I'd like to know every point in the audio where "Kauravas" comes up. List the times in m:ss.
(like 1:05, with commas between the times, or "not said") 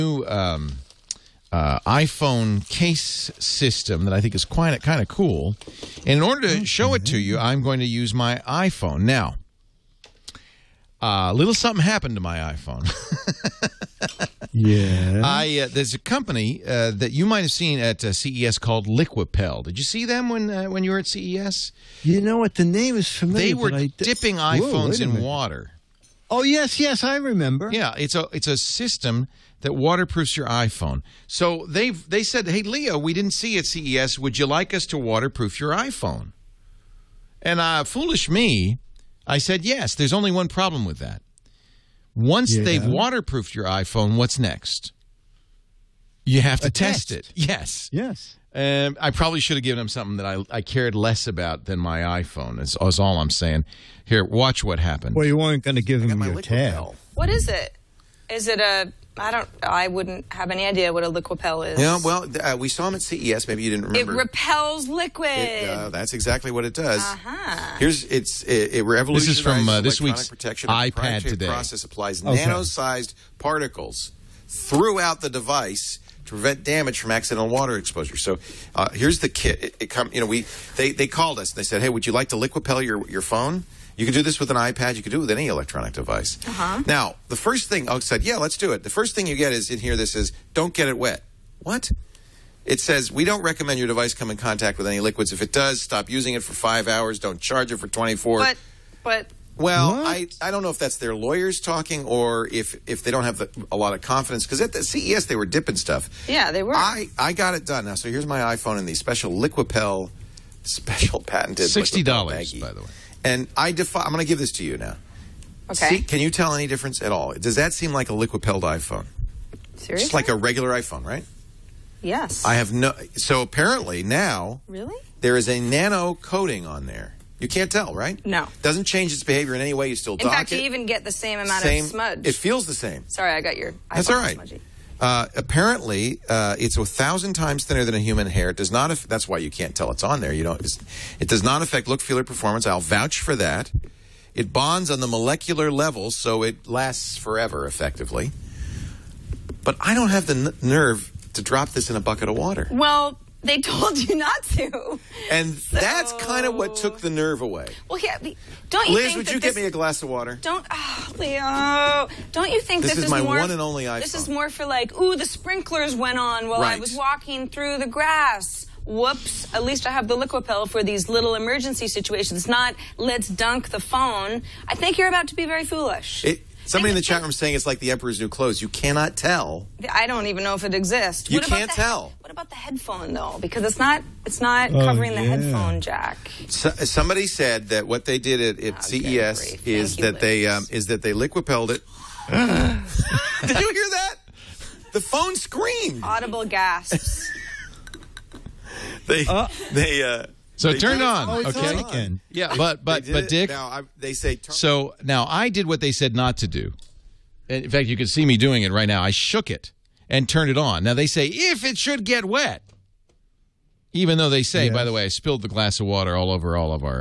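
not said.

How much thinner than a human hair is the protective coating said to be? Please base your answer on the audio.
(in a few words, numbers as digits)
A thousand times.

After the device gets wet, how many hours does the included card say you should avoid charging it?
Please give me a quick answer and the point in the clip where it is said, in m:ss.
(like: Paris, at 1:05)
24, at 1:37.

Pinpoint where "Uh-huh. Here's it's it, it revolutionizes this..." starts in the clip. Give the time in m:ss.
1:07.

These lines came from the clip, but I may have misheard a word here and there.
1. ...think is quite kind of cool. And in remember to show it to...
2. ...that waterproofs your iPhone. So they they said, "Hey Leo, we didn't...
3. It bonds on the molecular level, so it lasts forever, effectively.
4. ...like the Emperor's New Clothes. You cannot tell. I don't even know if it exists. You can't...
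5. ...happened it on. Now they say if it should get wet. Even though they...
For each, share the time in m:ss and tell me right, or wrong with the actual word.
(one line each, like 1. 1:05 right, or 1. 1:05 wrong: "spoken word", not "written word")
1. 0:04 wrong: "order", not "remember"
2. 0:29 right
3. 2:24 right
4. 2:57 right
5. 3:30 wrong: "turned", not "happened".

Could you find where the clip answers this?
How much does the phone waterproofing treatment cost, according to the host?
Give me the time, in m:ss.
1:51.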